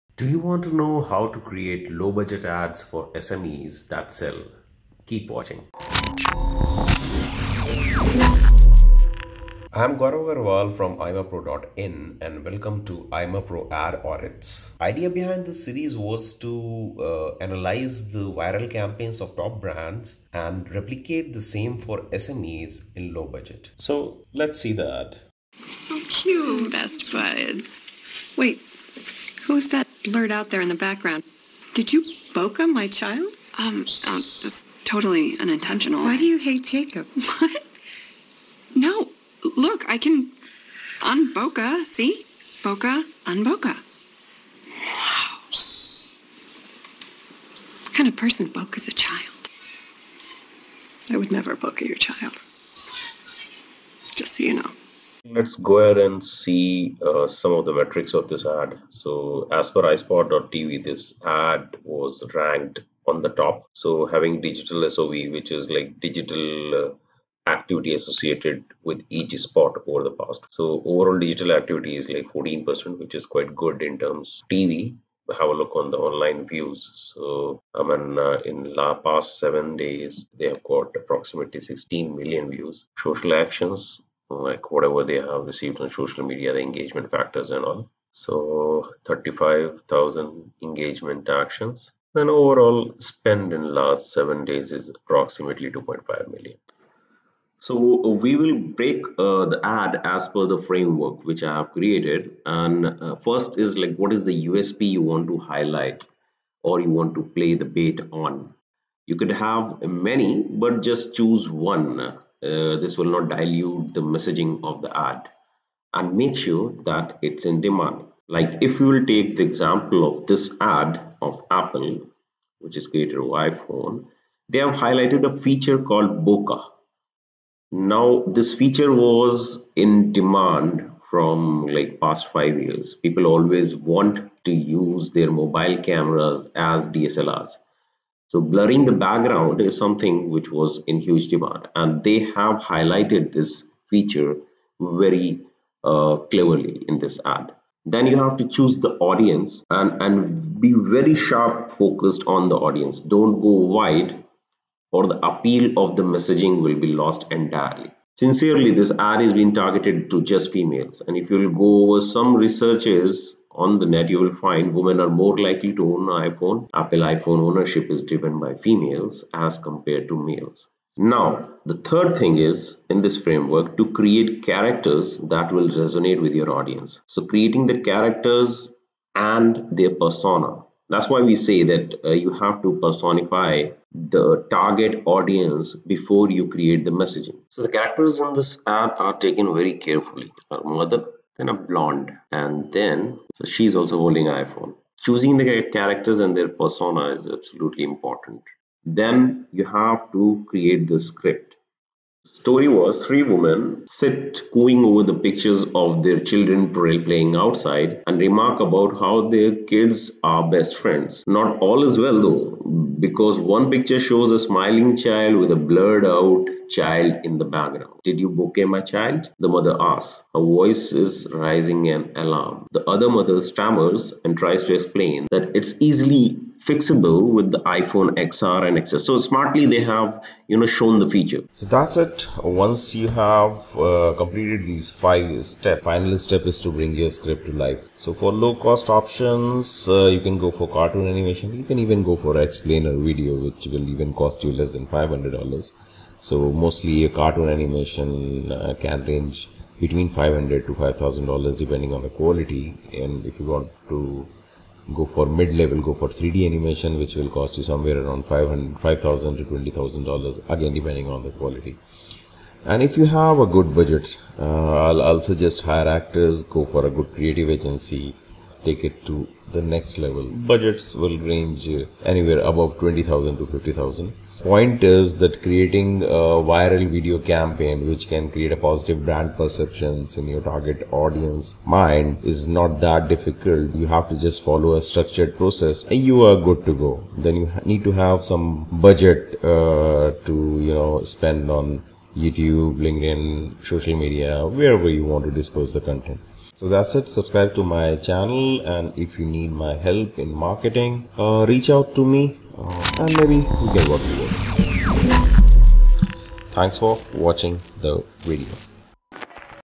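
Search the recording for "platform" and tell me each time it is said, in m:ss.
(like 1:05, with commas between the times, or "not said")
not said.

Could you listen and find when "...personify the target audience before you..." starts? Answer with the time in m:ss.
3:02.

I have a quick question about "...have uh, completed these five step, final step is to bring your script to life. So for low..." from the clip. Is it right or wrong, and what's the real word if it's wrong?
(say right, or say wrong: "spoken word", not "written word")
right.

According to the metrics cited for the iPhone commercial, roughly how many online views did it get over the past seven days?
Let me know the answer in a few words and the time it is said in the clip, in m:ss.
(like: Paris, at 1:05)
16 million, at 1:21.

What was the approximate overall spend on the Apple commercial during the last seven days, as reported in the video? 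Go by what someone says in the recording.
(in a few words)
2.5 million.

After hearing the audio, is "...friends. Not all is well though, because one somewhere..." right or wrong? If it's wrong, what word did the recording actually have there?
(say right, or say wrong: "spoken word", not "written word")
wrong: "picture", not "somewhere".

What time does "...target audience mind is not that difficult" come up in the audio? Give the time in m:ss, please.
4:40.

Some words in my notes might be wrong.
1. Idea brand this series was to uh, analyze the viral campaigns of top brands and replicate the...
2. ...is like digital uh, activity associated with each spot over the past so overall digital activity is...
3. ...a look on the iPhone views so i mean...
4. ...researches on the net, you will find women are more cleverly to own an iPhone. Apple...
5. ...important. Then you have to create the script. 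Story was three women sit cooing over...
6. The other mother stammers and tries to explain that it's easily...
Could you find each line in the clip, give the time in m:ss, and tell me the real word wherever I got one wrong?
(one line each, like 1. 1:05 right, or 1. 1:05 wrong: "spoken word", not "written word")
1. 0:14 wrong: "behind", not "brand"
2. 1:05 right
3. 1:15 wrong: "online", not "iPhone"
4. 2:42 wrong: "likely", not "cleverly"
5. 3:17 right
6. 3:42 right.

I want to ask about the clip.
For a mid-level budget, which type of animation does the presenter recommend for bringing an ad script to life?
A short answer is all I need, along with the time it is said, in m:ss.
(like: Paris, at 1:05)
3D animation, at 4:16.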